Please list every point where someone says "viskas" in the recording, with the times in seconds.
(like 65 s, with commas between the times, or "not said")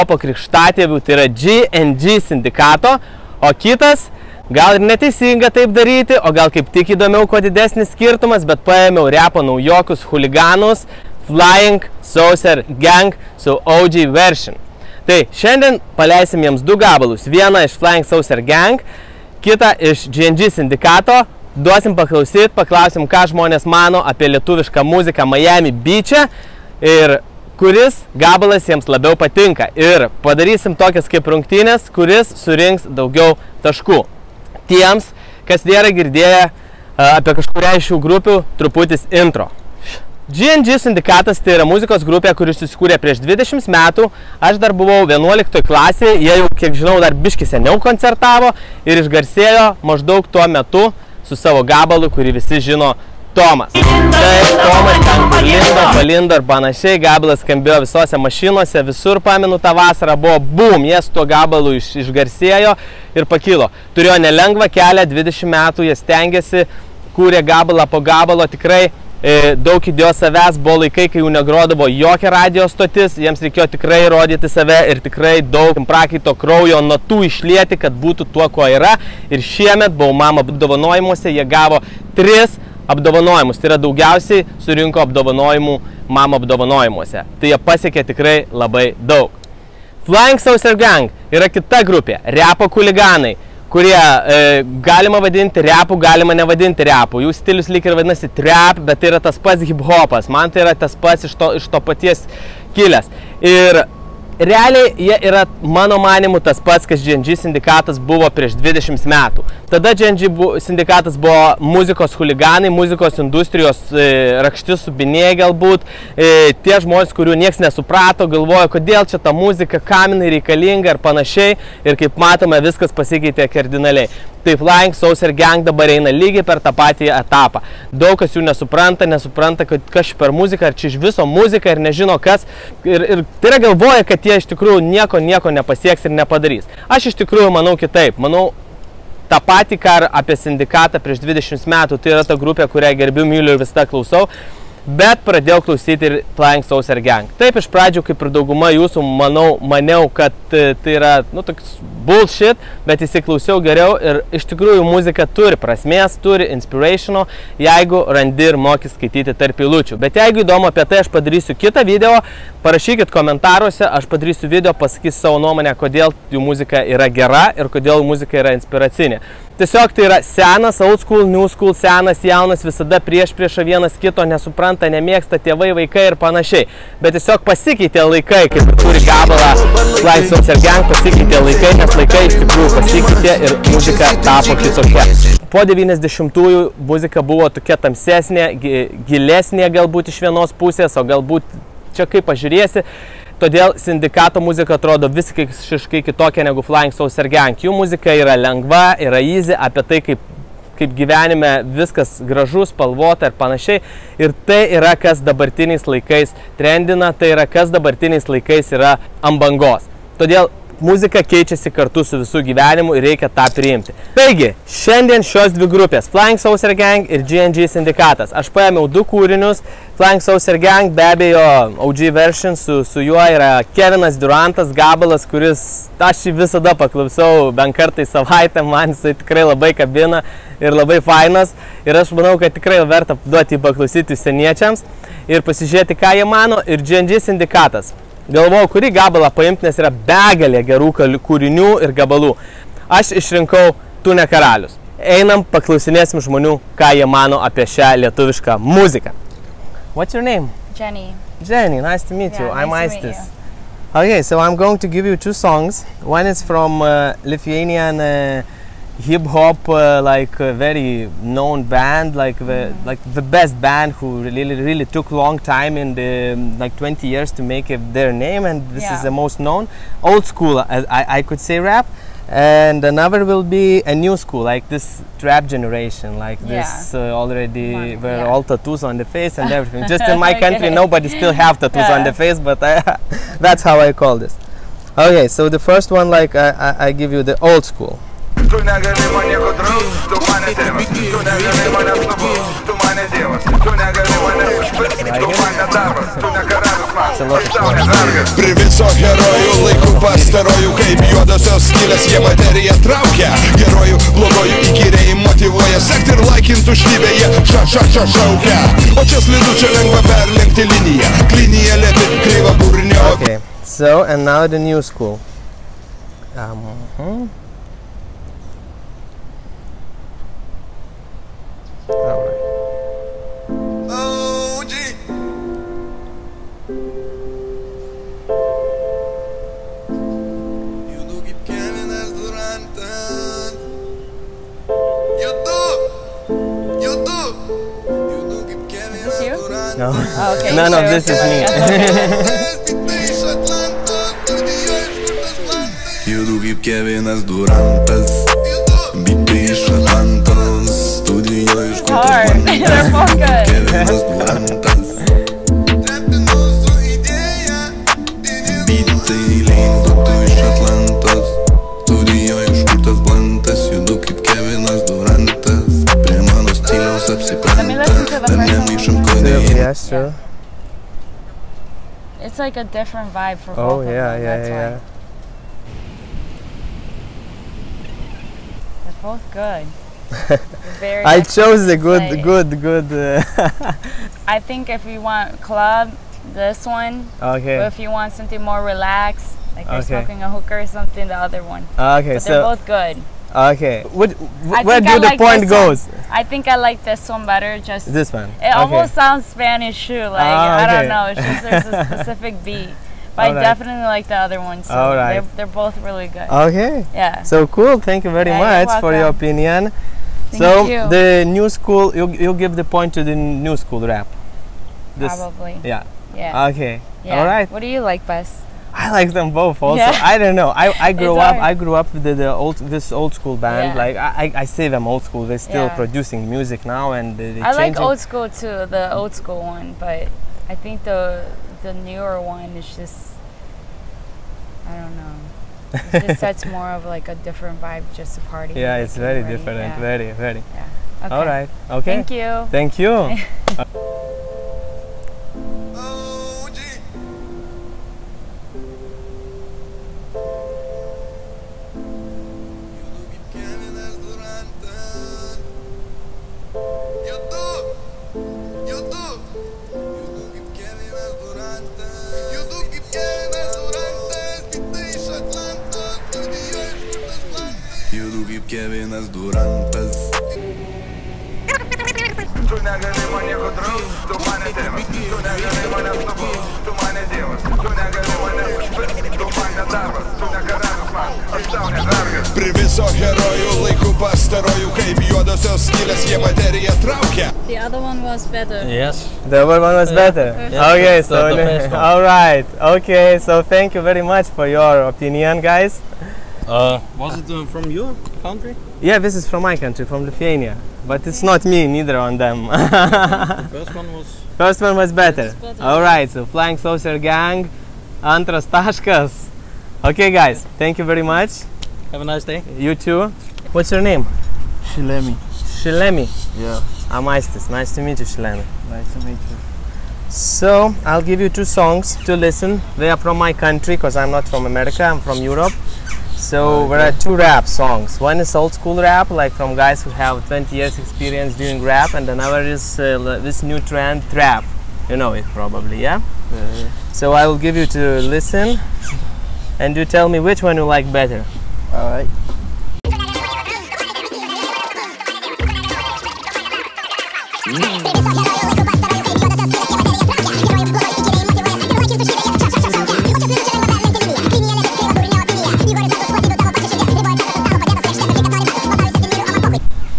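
122 s, 201 s.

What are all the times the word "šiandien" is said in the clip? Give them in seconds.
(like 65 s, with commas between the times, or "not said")
15 s, 214 s.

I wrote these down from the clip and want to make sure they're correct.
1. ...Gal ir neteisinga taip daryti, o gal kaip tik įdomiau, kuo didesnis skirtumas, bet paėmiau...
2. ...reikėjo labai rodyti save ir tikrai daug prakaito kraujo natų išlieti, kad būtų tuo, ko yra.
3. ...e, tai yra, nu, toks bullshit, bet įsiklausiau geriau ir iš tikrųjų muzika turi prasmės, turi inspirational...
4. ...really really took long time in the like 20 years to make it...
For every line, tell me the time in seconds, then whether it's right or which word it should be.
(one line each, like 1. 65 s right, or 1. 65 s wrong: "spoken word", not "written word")
1. 4 s right
2. 73 s wrong: "tikrai", not "labai"
3. 150 s right
4. 264 s right.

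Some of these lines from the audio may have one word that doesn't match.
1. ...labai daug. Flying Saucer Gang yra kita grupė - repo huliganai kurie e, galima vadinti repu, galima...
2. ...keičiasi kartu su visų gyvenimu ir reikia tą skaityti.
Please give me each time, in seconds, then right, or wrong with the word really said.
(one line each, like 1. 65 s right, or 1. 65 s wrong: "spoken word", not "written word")
1. 88 s right
2. 211 s wrong: "priimti", not "skaityti".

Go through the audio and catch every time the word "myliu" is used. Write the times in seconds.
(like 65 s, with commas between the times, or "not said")
143 s.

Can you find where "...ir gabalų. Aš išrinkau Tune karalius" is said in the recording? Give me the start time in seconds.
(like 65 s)
241 s.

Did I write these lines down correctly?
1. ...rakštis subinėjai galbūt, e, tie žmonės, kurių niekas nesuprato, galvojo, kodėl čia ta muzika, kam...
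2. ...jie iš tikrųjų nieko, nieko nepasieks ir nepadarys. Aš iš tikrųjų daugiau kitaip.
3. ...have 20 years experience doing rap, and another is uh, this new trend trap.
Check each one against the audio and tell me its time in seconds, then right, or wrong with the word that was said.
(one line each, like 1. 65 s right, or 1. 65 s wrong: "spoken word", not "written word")
1. 114 s right
2. 134 s wrong: "manau", not "daugiau"
3. 529 s right.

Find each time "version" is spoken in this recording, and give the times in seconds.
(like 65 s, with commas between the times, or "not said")
14 s, 222 s.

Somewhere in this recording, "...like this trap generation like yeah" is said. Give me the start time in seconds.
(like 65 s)
274 s.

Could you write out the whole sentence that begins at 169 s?
Tiesiog tai yra senas, old school, new school, senas, jaunas, visada prieš priešą vienas kito, nesupranta, nemėgsta tėvai, vaikai ir panašiai.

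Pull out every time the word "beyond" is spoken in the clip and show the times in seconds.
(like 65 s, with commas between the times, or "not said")
not said.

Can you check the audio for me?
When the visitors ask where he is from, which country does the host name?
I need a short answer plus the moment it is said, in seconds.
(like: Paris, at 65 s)
Lithuania, at 500 s.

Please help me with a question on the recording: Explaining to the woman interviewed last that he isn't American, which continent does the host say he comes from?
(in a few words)
Europe.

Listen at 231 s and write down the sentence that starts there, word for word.
Ir aš manau, kad tikrai verta duoti paklausyti seniečiams ir pasižiūrėti, ką jie mano.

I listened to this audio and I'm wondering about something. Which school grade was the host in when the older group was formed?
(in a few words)
11th grade.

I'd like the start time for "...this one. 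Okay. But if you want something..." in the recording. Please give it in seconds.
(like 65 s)
386 s.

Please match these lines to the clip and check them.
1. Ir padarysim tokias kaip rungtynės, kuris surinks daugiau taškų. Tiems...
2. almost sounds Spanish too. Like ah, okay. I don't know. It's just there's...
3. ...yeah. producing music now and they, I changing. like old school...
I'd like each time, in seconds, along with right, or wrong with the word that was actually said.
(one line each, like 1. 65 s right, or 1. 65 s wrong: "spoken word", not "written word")
1. 29 s right
2. 398 s right
3. 425 s right.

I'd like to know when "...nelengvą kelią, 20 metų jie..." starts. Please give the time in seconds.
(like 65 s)
64 s.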